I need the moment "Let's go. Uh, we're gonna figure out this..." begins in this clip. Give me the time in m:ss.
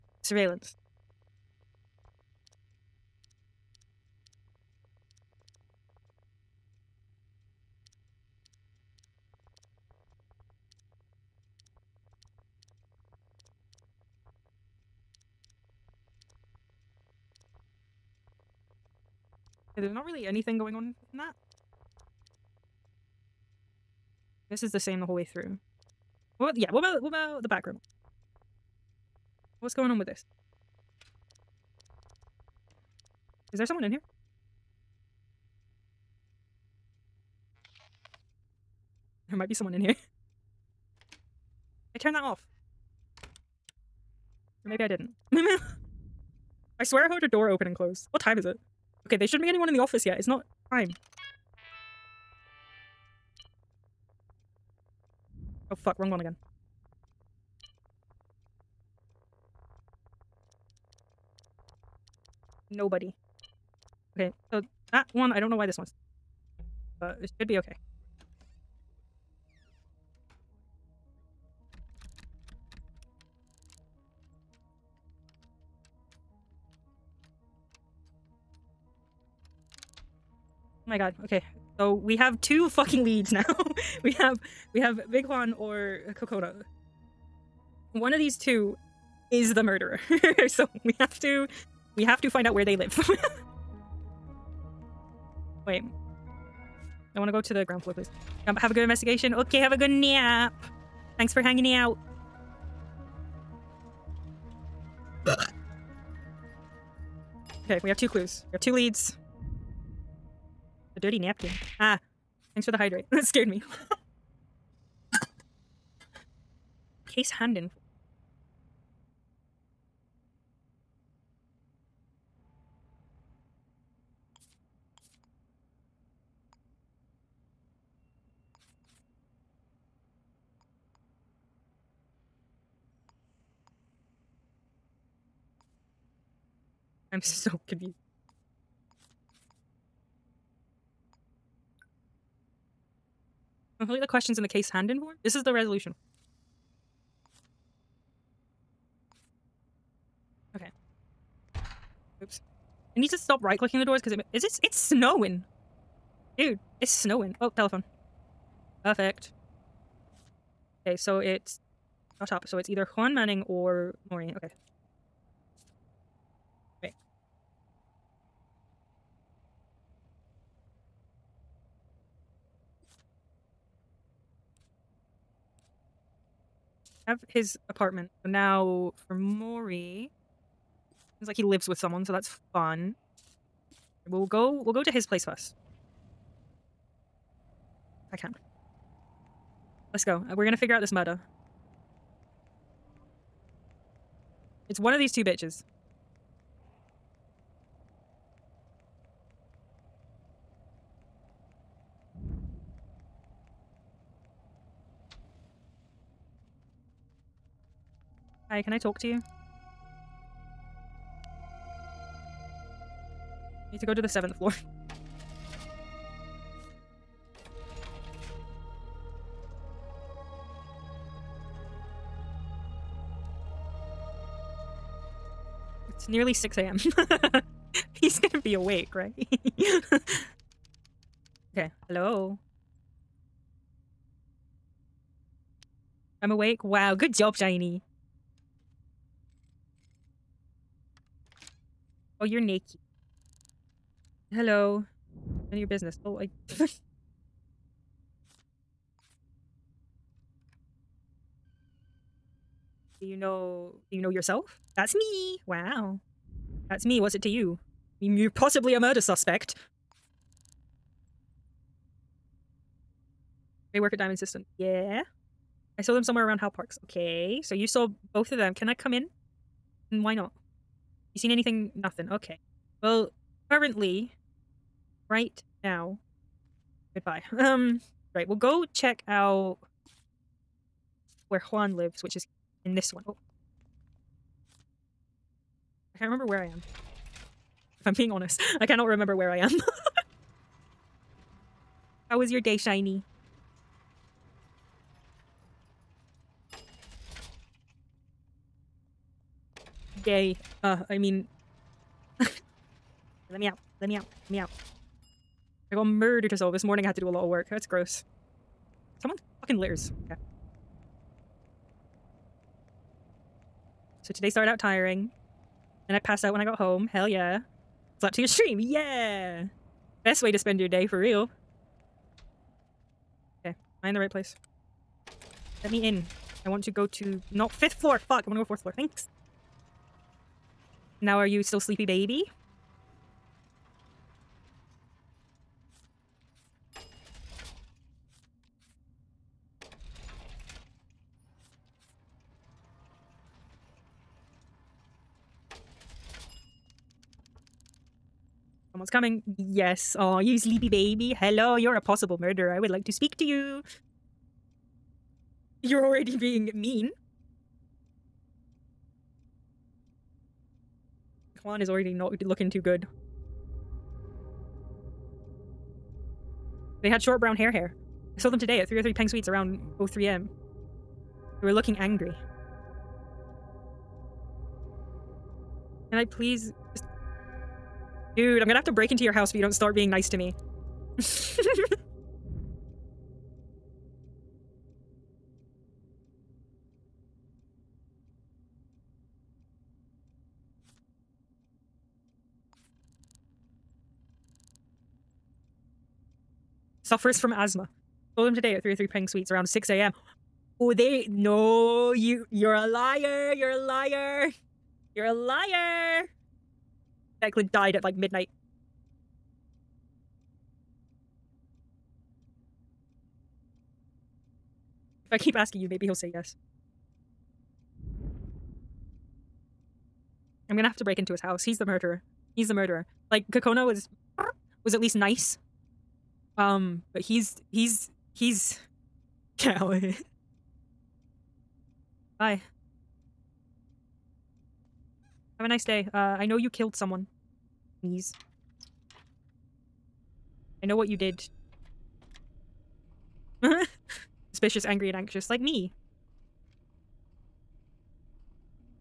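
3:09.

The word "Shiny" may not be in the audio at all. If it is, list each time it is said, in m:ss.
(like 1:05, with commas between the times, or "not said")
3:57, 4:52.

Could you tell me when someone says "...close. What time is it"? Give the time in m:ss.
0:47.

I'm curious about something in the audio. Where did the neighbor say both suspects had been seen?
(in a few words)
Hal Parks.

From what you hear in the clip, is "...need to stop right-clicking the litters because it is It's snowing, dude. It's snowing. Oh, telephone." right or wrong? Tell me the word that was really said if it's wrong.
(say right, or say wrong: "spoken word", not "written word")
wrong: "doors", not "litters".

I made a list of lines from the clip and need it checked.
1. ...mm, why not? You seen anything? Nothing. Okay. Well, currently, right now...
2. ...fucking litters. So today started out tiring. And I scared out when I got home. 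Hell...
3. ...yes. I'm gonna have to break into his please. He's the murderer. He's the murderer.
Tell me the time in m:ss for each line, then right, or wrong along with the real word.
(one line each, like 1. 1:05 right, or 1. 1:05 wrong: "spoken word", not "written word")
1. 4:29 right
2. 5:09 wrong: "passed", not "scared"
3. 6:56 wrong: "house", not "please".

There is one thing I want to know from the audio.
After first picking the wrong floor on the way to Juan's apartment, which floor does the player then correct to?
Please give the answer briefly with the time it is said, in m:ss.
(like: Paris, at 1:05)
fourth floor, at 5:28.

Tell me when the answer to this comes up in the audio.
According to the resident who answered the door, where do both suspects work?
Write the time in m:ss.
4:23.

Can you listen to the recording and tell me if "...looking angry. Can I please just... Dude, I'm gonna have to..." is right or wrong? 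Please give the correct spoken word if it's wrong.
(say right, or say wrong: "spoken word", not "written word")
right.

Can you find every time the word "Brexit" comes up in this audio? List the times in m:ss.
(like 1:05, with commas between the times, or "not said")
not said.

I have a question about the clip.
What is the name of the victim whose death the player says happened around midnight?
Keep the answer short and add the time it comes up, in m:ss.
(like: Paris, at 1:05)
Declan, at 6:47.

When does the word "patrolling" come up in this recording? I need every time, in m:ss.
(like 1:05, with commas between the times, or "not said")
not said.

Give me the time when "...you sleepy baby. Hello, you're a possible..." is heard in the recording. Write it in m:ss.
5:50.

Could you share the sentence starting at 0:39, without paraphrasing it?
There might be someone in here.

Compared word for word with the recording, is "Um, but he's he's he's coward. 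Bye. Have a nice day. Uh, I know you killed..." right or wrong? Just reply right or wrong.
right.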